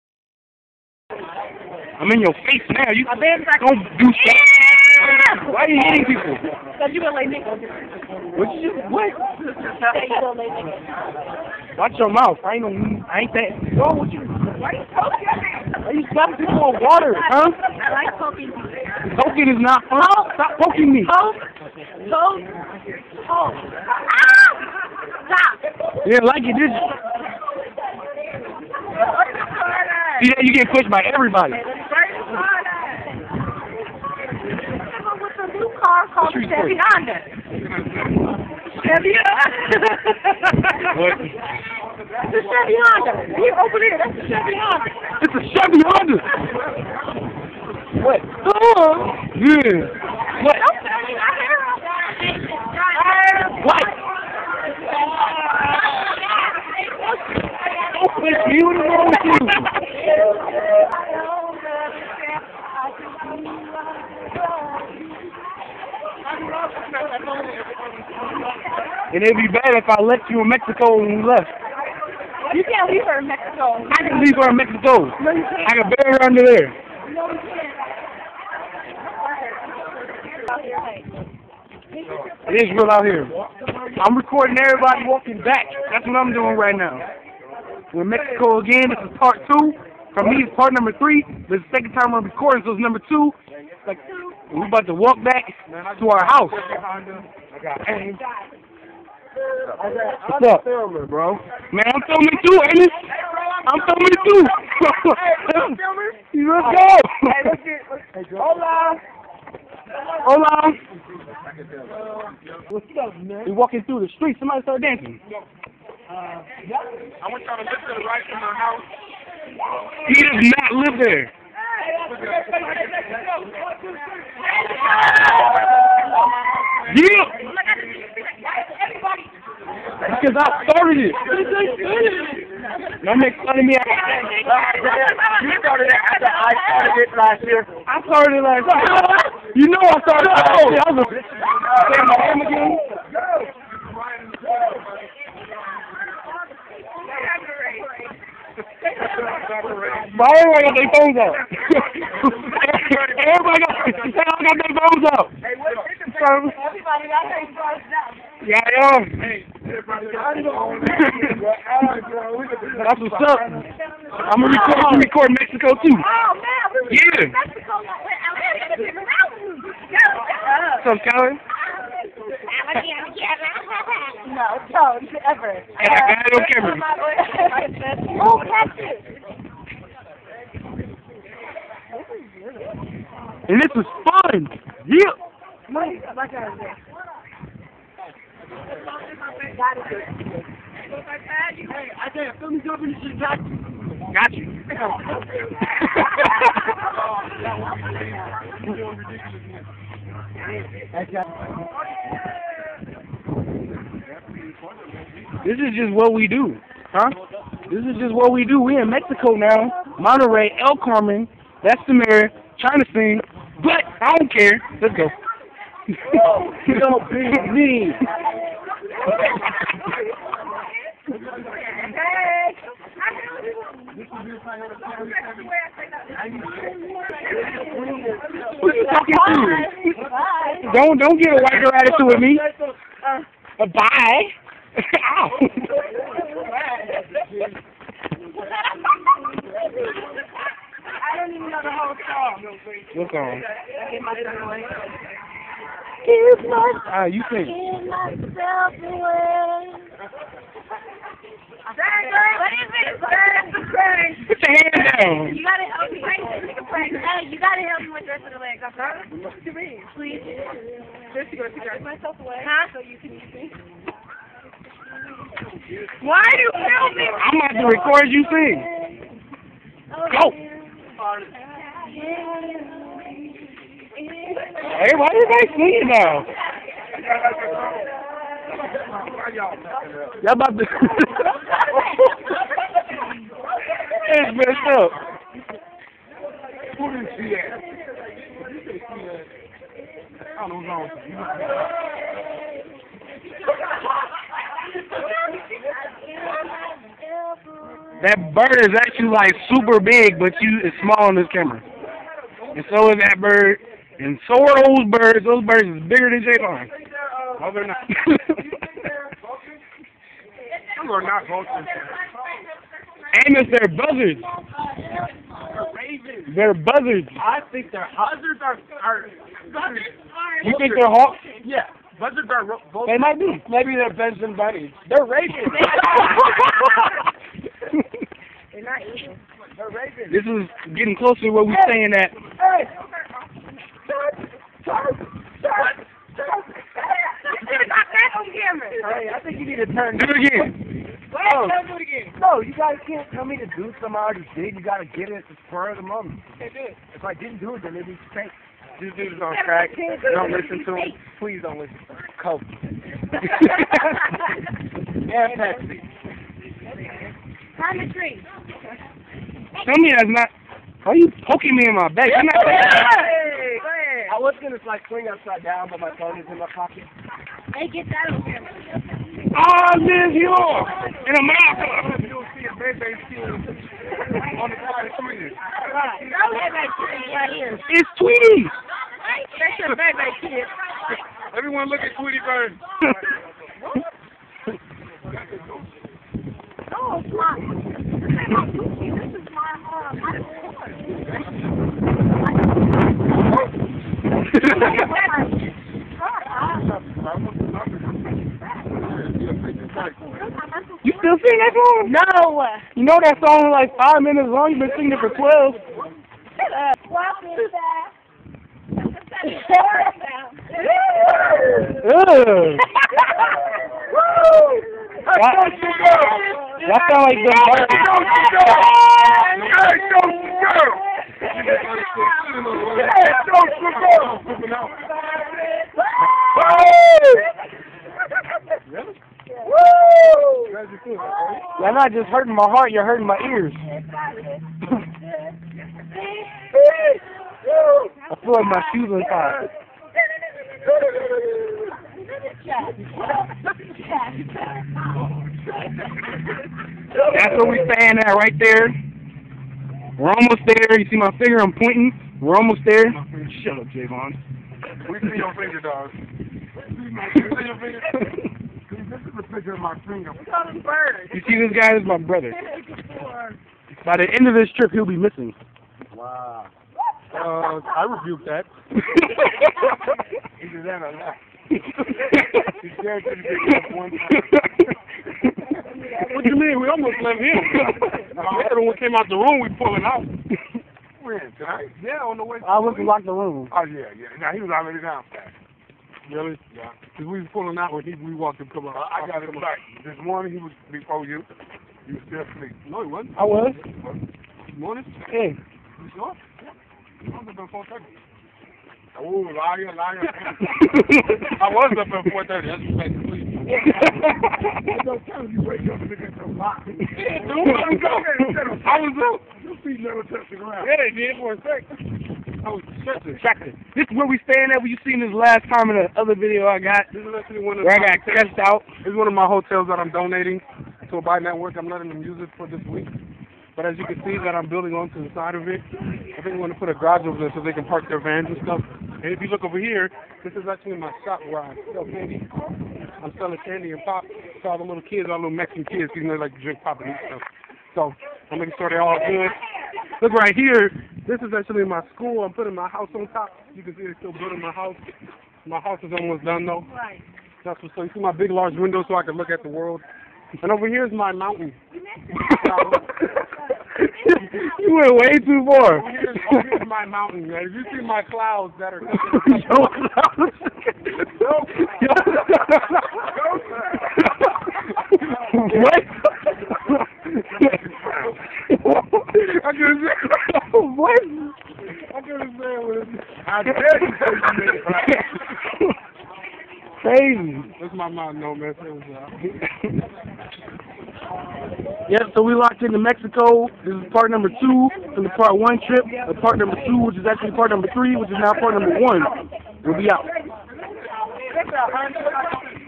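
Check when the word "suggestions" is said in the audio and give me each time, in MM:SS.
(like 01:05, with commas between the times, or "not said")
not said.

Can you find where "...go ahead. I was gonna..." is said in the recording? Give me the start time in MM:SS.
06:03.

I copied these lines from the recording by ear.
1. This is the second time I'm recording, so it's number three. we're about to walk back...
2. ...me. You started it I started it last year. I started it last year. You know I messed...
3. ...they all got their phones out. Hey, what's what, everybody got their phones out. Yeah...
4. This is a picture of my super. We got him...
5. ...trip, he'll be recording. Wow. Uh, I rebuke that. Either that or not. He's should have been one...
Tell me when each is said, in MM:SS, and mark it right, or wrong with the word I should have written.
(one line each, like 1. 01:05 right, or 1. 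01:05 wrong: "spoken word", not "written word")
1. 01:31 wrong: "two", not "three"
2. 02:13 wrong: "started", not "messed"
3. 02:33 right
4. 07:38 wrong: "finger", not "super"
5. 07:44 wrong: "missing", not "recording".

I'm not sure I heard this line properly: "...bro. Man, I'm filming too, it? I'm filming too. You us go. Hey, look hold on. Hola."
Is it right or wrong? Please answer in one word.
right.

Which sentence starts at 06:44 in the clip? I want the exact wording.
You've been singing it for 12.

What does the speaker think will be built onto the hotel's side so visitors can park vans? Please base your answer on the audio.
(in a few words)
A garage.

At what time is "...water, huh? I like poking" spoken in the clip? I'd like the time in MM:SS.
00:16.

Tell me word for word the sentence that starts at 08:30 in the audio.
Yeah, they did for a second.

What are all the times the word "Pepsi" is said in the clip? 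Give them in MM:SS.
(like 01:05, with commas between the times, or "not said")
05:55.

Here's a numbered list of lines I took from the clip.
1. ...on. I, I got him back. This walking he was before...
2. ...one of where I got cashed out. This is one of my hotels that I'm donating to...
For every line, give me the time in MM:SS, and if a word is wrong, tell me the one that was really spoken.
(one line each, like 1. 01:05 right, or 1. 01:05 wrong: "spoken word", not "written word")
1. 08:08 wrong: "morning", not "walking"
2. 08:37 right.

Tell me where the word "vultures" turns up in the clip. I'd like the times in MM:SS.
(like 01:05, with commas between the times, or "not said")
05:11, 05:22.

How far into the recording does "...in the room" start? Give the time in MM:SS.
08:02.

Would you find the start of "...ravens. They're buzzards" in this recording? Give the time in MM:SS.
05:15.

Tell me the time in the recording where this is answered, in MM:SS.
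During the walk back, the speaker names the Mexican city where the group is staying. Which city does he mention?
03:29.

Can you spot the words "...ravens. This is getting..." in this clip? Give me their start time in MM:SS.
05:29.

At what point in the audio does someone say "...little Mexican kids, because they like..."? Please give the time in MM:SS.
08:55.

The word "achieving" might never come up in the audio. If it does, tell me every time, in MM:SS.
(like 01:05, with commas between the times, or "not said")
not said.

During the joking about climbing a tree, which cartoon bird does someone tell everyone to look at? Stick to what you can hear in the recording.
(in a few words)
Tweety Bird.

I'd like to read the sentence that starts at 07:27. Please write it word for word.
That's where we stand at right there.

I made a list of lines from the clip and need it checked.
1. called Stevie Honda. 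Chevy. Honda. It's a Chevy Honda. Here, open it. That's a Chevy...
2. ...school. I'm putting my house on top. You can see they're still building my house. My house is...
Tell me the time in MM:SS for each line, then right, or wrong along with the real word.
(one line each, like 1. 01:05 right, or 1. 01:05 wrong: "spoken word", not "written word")
1. 00:36 right
2. 09:01 right.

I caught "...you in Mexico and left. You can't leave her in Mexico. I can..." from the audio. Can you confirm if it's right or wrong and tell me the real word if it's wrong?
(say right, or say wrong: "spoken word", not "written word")
right.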